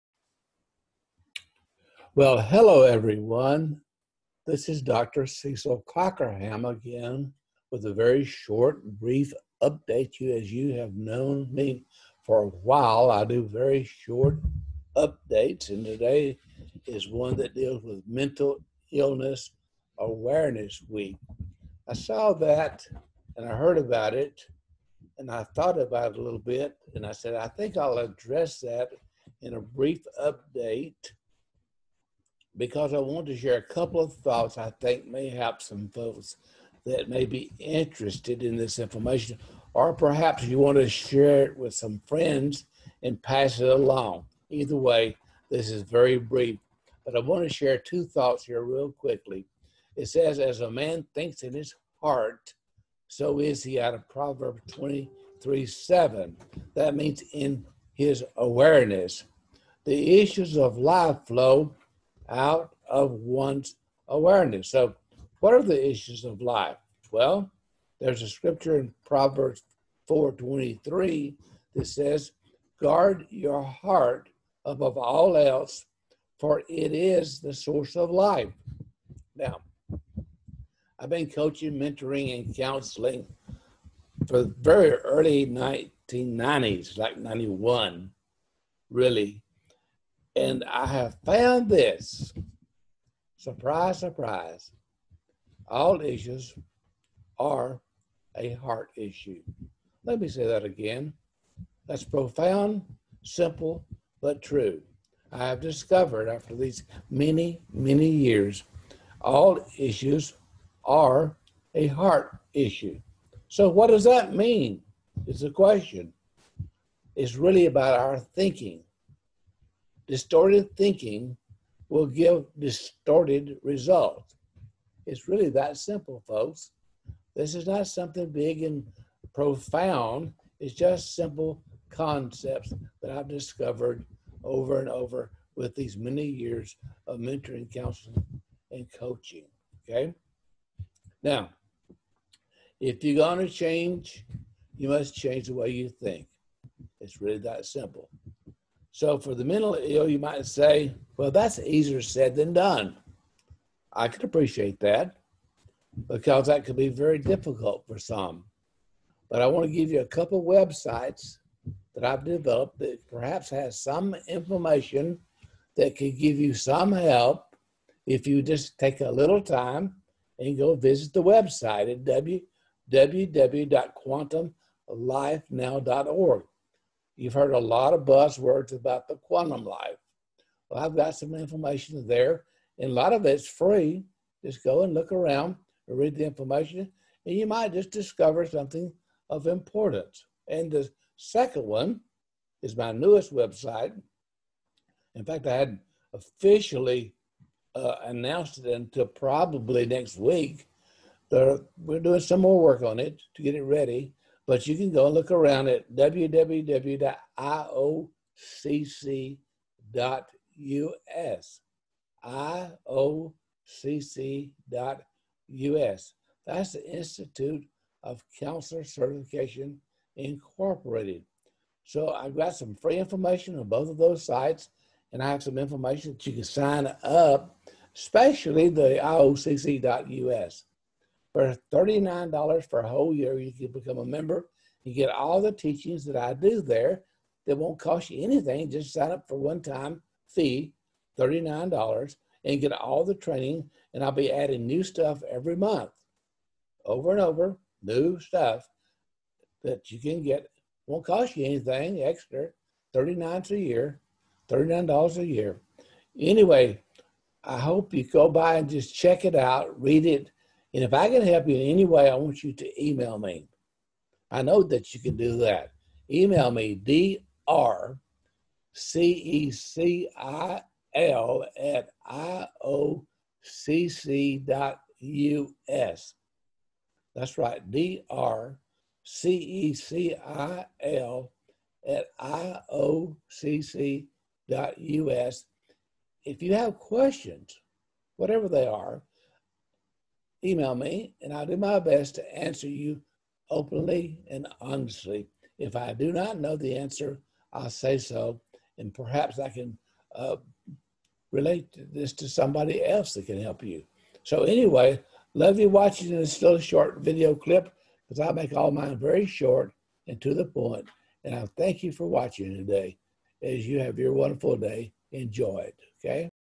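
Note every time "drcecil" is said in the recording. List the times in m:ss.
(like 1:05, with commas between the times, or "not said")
4:27, 4:37.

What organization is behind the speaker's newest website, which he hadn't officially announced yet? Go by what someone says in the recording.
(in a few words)
Institute of Counselor Certification Incorporated.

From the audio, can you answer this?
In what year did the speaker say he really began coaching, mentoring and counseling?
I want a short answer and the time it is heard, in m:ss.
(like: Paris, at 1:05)
1991, at 1:27.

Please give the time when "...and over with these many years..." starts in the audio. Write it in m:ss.
2:14.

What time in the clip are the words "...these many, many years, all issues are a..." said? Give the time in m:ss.
1:46.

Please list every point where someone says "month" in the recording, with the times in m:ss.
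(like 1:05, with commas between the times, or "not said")
4:05.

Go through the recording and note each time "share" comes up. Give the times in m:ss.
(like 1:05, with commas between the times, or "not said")
0:33, 0:40, 0:47.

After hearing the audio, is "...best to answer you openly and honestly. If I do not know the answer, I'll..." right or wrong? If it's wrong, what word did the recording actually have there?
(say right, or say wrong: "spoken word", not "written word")
right.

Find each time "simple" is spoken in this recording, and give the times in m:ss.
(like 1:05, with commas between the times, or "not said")
1:43, 2:05, 2:11, 2:27.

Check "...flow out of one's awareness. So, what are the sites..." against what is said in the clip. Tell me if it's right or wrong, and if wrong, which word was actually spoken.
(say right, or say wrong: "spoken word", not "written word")
wrong: "issues", not "sites".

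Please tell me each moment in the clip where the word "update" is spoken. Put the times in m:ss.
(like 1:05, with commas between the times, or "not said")
0:09, 0:14, 0:30.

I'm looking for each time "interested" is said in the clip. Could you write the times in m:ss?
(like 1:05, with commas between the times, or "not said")
0:37.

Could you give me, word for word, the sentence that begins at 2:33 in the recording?
I can appreciate that because that could be very difficult for some.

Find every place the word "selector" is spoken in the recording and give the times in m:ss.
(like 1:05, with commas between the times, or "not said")
not said.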